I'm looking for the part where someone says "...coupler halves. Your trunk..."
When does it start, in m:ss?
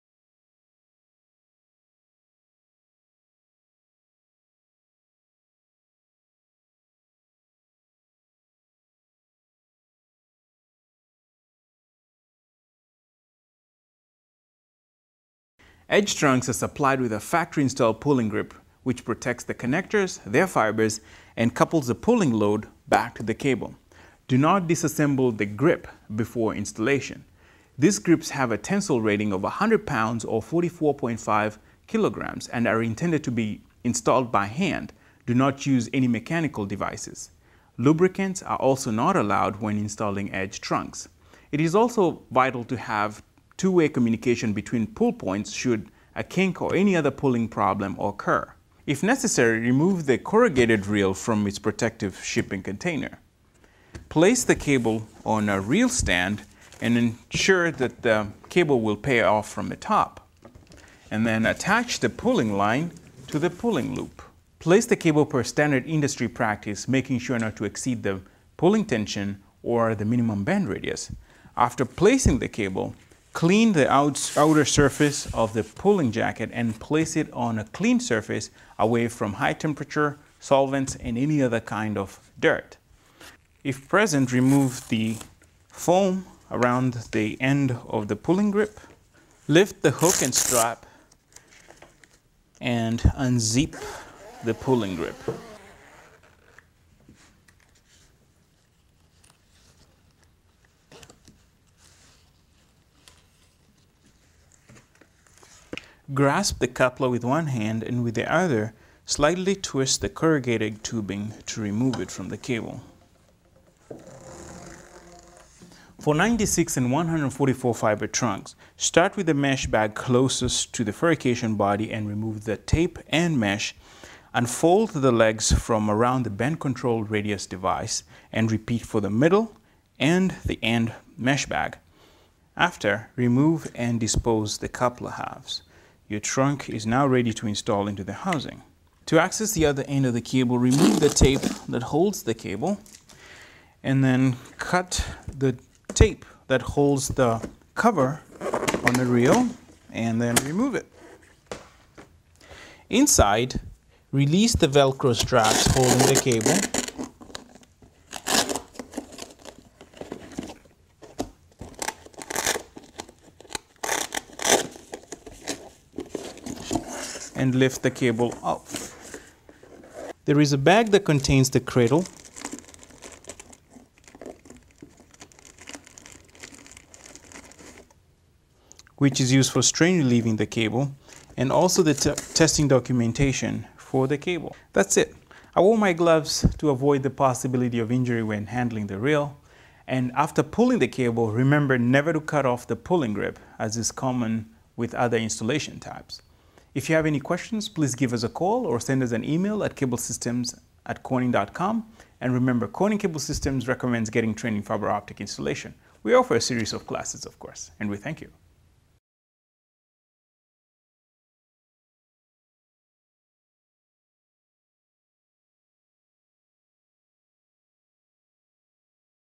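2:14.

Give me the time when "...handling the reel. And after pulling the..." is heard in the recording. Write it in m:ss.
3:08.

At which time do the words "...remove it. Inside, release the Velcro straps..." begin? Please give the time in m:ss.
2:30.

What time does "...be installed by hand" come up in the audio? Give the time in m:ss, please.
0:33.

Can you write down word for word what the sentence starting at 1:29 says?
Lift the hook and strap and unzip the pulling grip.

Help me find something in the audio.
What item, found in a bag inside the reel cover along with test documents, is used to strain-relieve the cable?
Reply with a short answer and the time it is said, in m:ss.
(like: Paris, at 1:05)
cradle, at 2:51.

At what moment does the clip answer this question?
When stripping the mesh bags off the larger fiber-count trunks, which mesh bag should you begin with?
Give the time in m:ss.
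1:59.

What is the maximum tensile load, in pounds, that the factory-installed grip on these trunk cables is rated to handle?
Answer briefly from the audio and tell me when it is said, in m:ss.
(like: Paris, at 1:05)
100 pounds, at 0:29.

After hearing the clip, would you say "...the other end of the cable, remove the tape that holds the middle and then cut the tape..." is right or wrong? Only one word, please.
wrong.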